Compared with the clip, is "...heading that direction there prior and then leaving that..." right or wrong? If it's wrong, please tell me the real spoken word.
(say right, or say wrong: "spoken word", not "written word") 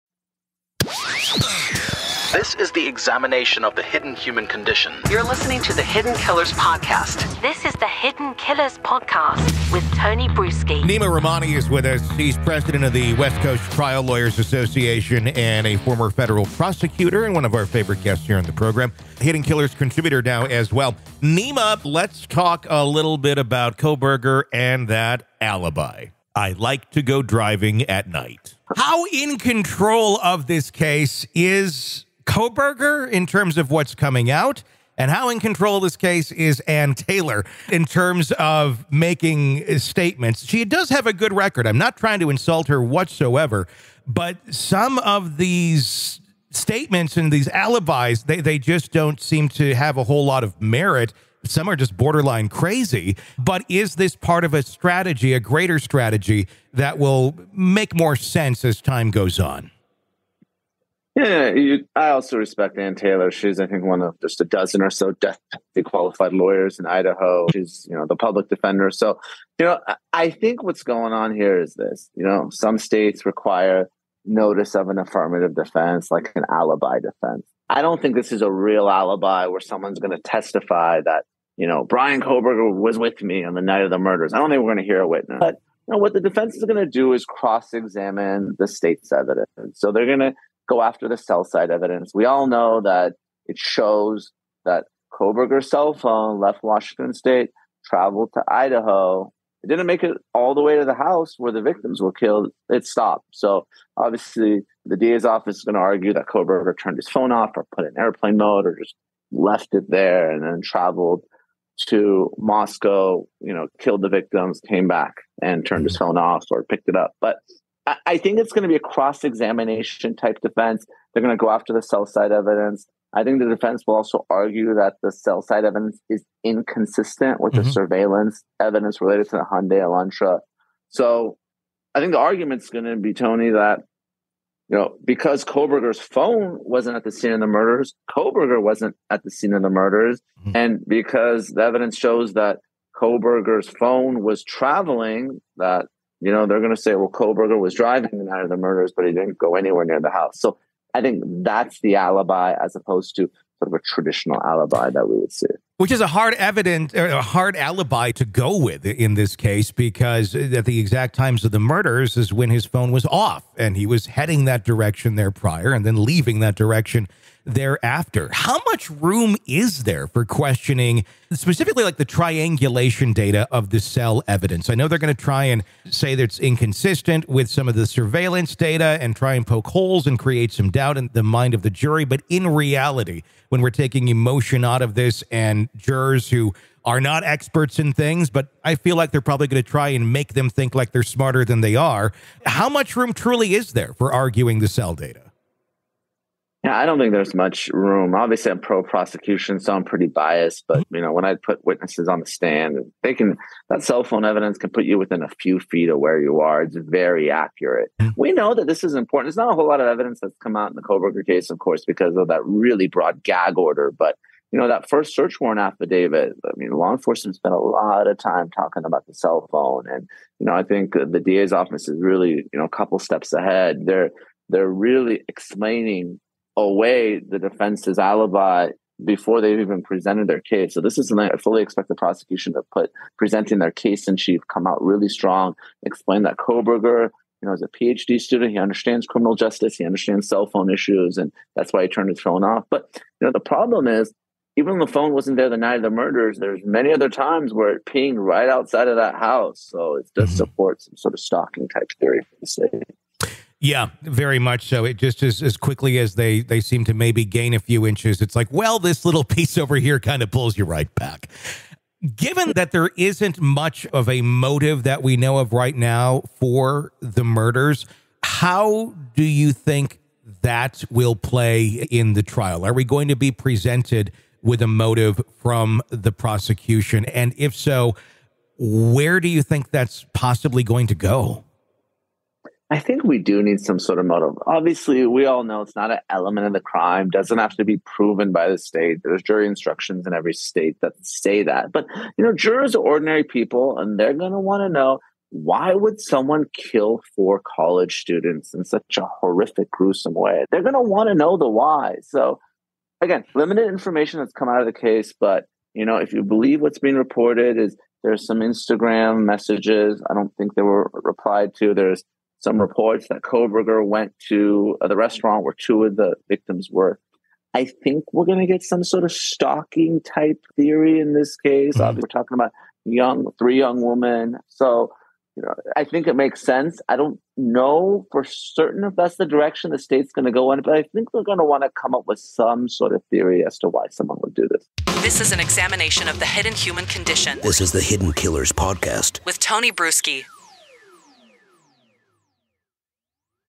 right.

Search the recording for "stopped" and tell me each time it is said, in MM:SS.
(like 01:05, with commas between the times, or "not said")
01:42.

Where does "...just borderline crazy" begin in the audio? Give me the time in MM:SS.
00:51.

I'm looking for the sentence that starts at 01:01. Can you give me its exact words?
Yeah, you, I also respect Anne Taylor.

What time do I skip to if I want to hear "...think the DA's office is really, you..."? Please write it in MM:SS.
03:40.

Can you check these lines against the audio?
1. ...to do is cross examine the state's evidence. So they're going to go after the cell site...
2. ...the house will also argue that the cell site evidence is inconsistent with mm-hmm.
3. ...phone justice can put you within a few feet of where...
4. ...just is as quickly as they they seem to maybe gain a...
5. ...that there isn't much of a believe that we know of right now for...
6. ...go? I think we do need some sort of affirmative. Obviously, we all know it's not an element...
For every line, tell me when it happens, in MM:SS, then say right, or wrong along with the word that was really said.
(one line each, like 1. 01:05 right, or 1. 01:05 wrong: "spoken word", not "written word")
1. 01:26 right
2. 02:03 wrong: "defense", not "house"
3. 03:24 wrong: "evidence", not "justice"
4. 04:14 right
5. 04:22 wrong: "motive", not "believe"
6. 04:40 wrong: "motive", not "affirmative".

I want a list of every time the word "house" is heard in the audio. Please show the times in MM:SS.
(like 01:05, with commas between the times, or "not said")
01:40, 02:30, 04:09.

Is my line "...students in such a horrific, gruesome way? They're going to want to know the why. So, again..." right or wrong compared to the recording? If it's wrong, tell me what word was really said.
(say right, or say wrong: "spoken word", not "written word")
right.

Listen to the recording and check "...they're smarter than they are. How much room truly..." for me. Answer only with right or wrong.
right.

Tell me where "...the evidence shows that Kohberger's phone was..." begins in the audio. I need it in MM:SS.
02:21.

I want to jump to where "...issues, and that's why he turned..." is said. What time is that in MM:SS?
04:00.